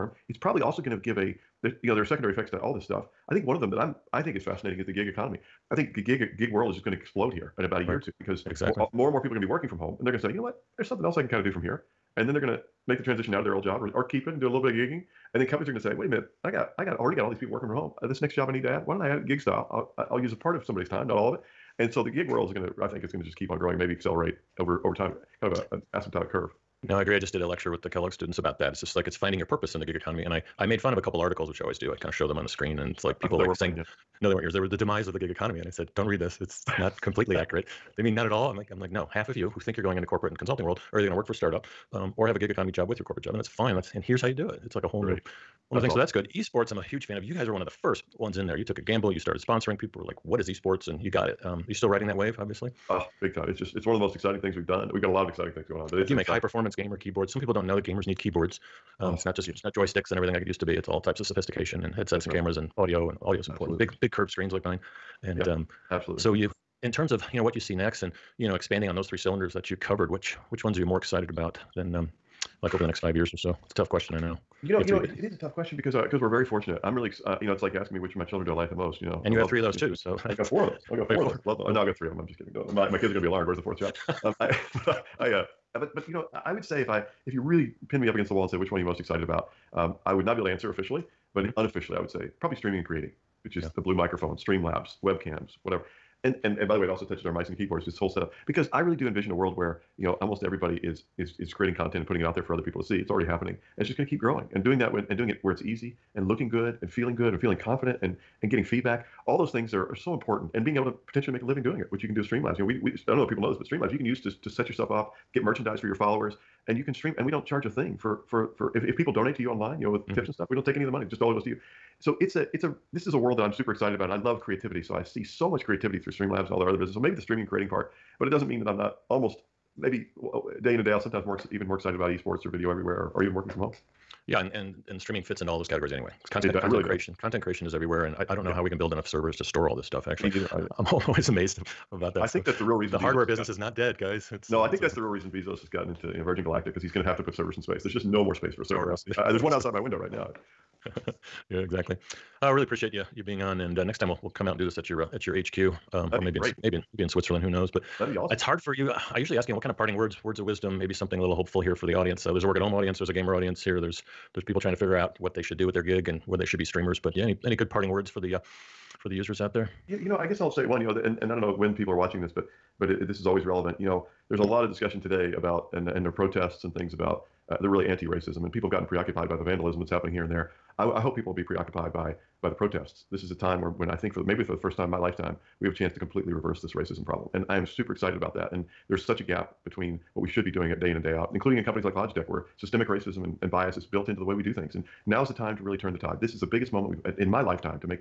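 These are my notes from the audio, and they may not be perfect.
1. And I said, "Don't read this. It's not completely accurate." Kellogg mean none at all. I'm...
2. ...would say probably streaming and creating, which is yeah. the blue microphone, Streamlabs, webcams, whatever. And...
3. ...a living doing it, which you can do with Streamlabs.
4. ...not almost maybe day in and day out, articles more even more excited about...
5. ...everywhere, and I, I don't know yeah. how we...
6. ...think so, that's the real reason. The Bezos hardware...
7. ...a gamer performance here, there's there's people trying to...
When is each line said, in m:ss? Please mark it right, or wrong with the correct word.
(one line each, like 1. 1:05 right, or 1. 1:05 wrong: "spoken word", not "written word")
1. 0:35 wrong: "They", not "Kellogg"
2. 1:31 right
3. 1:51 right
4. 2:08 wrong: "sometimes", not "articles"
5. 2:17 right
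6. 2:22 right
7. 2:43 wrong: "audience", not "performance".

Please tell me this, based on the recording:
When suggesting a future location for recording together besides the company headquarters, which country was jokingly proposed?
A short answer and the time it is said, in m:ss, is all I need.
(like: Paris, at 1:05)
Switzerland, at 2:37.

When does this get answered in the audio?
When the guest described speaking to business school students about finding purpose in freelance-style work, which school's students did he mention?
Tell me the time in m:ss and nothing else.
0:27.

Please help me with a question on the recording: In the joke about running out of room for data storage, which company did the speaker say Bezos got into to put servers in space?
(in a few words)
Virgin Galactic.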